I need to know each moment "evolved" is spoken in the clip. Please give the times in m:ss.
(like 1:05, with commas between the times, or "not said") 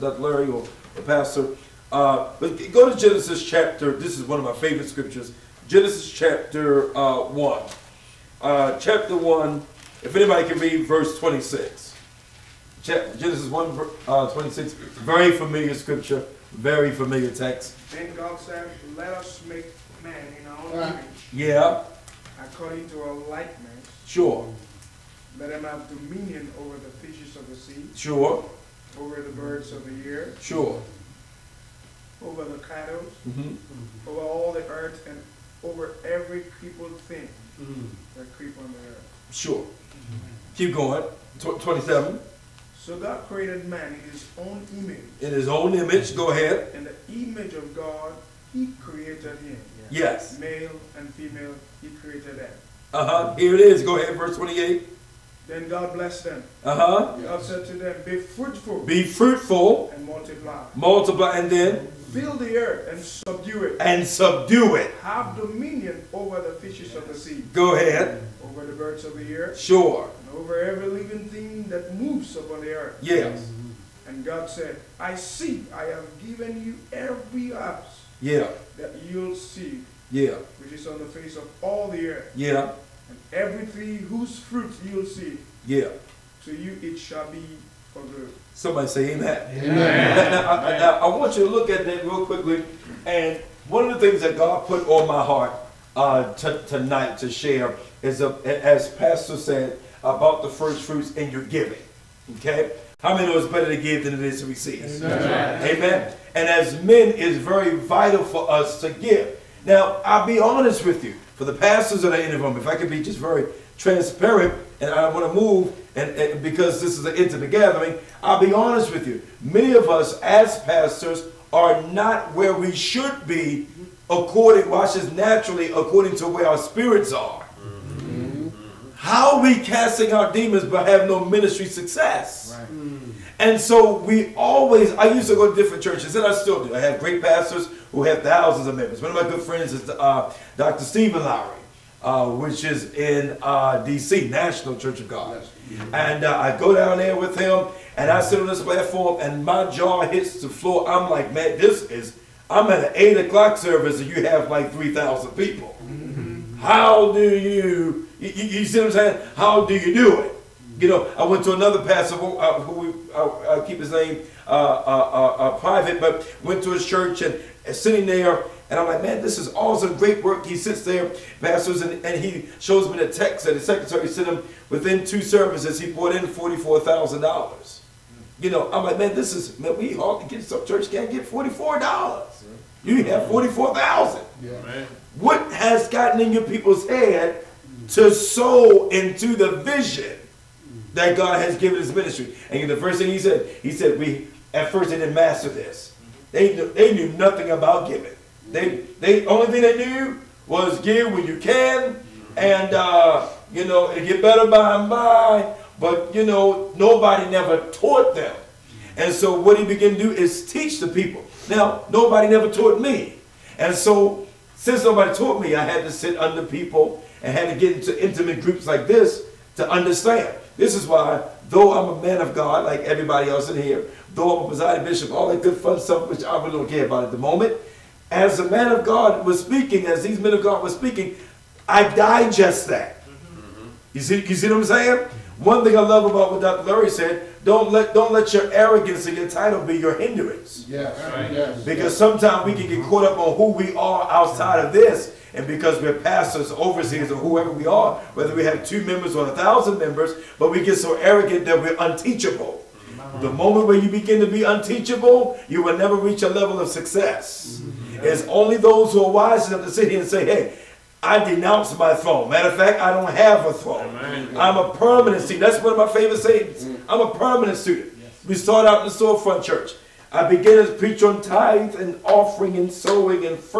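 not said.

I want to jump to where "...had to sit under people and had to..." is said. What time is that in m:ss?
3:35.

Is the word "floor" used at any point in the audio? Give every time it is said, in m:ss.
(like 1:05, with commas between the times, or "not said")
2:30.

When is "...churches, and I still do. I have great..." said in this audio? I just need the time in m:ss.
2:15.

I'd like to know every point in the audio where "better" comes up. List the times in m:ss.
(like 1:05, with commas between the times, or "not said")
1:43, 3:24.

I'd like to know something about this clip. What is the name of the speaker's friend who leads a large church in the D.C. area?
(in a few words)
Dr. Stephen Lowry.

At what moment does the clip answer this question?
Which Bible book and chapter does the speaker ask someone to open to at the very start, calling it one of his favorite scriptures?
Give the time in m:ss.
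0:05.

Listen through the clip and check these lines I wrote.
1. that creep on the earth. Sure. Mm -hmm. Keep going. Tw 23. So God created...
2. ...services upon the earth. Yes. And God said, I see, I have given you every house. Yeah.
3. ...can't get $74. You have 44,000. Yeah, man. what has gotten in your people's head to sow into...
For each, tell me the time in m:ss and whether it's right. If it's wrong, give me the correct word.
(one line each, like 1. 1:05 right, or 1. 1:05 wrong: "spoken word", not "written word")
1. 0:38 wrong: "27", not "23"
2. 1:11 wrong: "moves", not "services"
3. 3:00 wrong: "44", not "74".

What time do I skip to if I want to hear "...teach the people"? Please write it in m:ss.
3:30.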